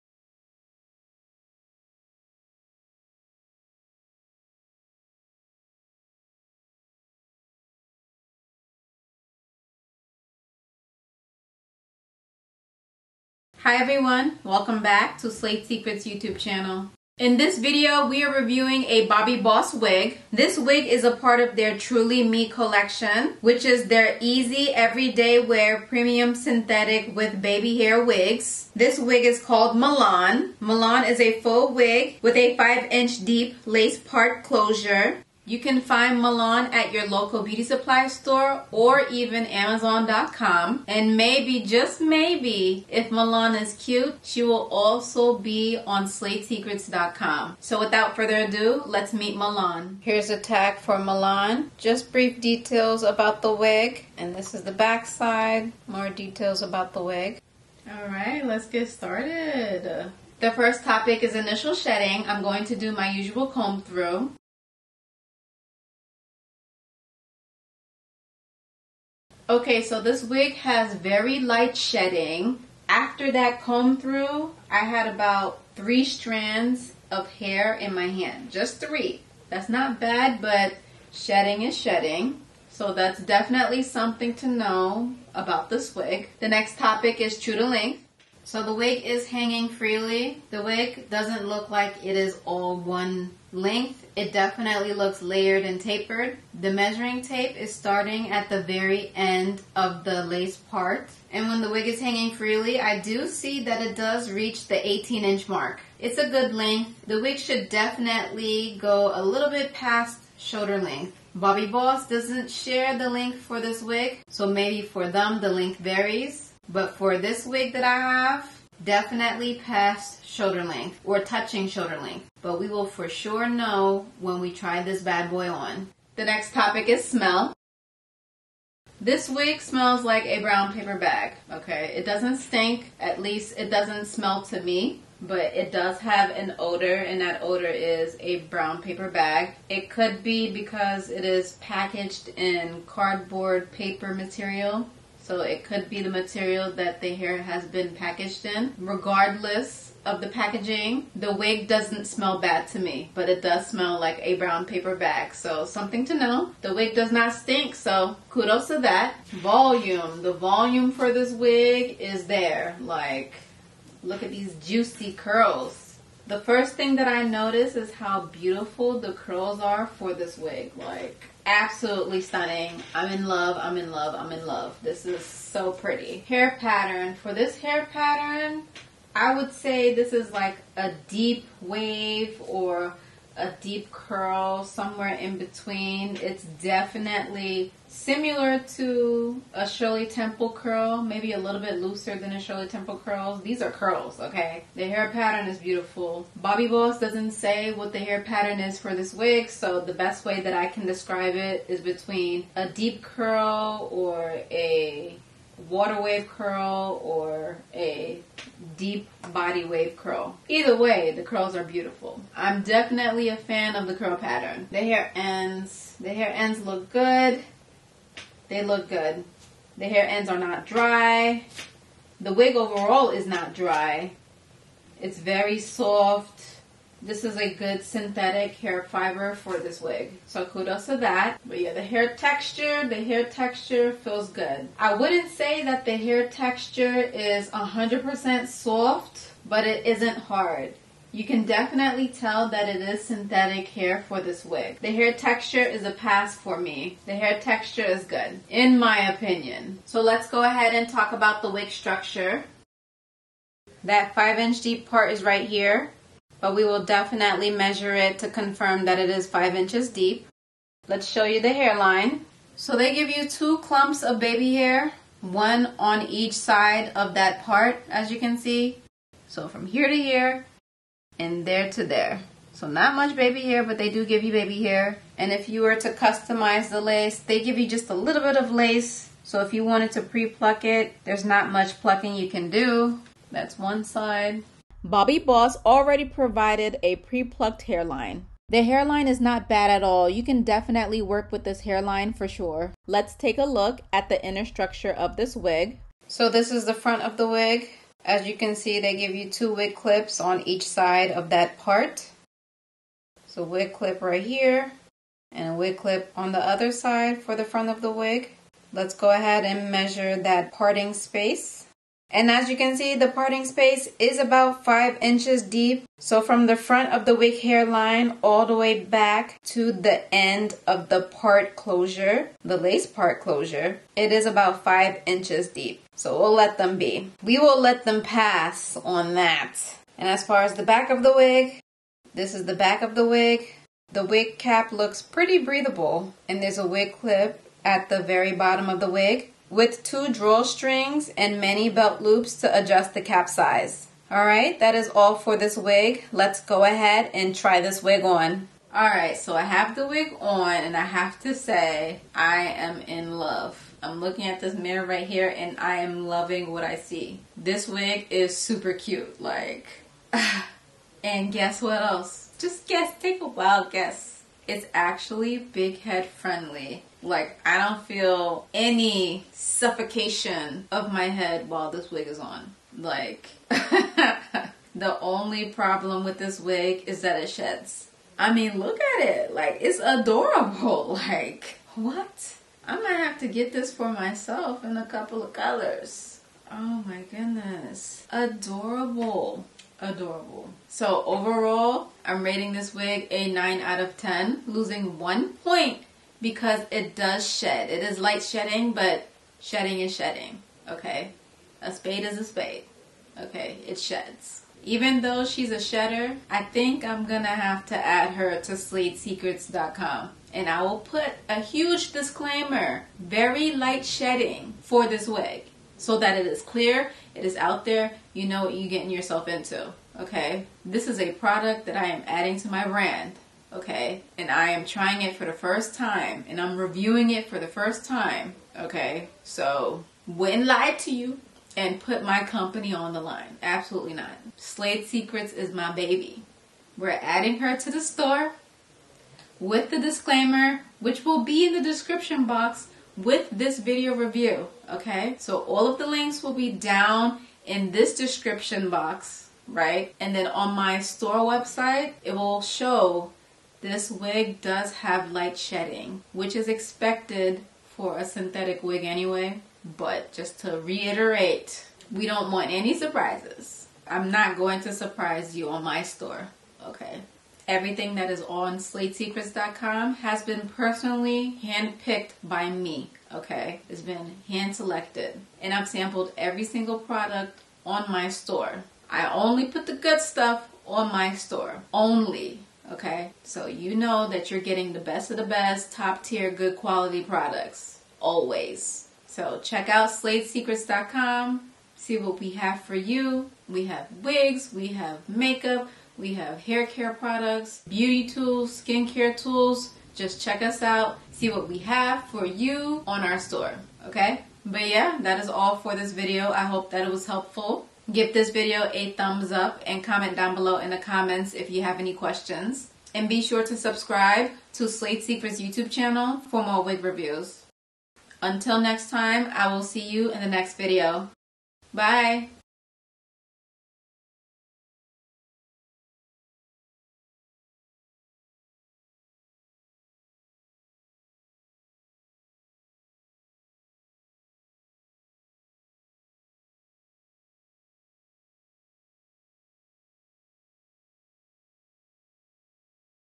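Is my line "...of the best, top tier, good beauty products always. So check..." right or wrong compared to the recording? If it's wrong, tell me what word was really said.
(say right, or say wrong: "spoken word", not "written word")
wrong: "quality", not "beauty".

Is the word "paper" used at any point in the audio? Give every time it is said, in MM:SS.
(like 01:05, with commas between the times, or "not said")
02:10, 02:18, 02:23, 02:34.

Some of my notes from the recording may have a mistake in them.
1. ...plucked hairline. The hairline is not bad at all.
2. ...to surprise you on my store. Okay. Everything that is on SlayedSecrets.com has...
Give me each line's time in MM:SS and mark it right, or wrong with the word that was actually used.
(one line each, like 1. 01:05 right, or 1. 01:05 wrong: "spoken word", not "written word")
1. 04:47 right
2. 07:44 right.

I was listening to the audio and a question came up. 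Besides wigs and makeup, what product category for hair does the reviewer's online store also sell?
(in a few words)
hair care products.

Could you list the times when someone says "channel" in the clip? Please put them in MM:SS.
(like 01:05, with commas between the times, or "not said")
00:16, 08:35.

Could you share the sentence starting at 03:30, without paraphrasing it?
Either way, the curls are beautiful.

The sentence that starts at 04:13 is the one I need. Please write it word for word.
That 5 inch deep part is right here but we will definitely measure it to confirm that it is 5 inches deep.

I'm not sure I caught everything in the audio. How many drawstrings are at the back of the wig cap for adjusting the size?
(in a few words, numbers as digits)
2.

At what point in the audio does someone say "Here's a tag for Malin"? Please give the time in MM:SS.
00:49.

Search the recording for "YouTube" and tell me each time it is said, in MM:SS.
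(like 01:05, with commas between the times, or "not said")
00:16, 08:35.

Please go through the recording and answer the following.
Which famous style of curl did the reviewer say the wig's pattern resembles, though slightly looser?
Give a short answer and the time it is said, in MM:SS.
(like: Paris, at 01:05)
Shirley Temple curl, at 03:09.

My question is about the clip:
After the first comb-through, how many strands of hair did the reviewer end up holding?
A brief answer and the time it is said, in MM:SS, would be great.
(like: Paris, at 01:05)
3, at 01:15.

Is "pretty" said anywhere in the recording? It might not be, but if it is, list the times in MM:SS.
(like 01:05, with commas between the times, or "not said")
02:55, 05:35.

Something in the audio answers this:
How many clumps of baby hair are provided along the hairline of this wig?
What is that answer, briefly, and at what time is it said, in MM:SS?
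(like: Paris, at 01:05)
2, at 04:23.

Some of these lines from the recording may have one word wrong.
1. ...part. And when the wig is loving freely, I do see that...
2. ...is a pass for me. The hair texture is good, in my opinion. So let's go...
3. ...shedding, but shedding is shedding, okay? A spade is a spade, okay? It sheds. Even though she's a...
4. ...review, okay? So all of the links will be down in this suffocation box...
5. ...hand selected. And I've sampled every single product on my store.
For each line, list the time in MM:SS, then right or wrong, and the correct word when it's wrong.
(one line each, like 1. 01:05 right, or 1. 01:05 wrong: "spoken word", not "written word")
1. 01:40 wrong: "hanging", not "loving"
2. 04:05 right
3. 06:38 right
4. 07:23 wrong: "description", not "suffocation"
5. 07:54 right.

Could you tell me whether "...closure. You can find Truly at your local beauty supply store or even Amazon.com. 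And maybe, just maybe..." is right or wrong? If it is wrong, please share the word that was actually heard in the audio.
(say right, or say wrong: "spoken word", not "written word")
wrong: "Malin", not "Truly".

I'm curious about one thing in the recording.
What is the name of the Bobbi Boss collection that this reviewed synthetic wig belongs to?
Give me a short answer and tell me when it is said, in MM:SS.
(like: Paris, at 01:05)
Truly Me, at 00:21.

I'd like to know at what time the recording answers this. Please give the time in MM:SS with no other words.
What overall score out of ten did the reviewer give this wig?
06:33.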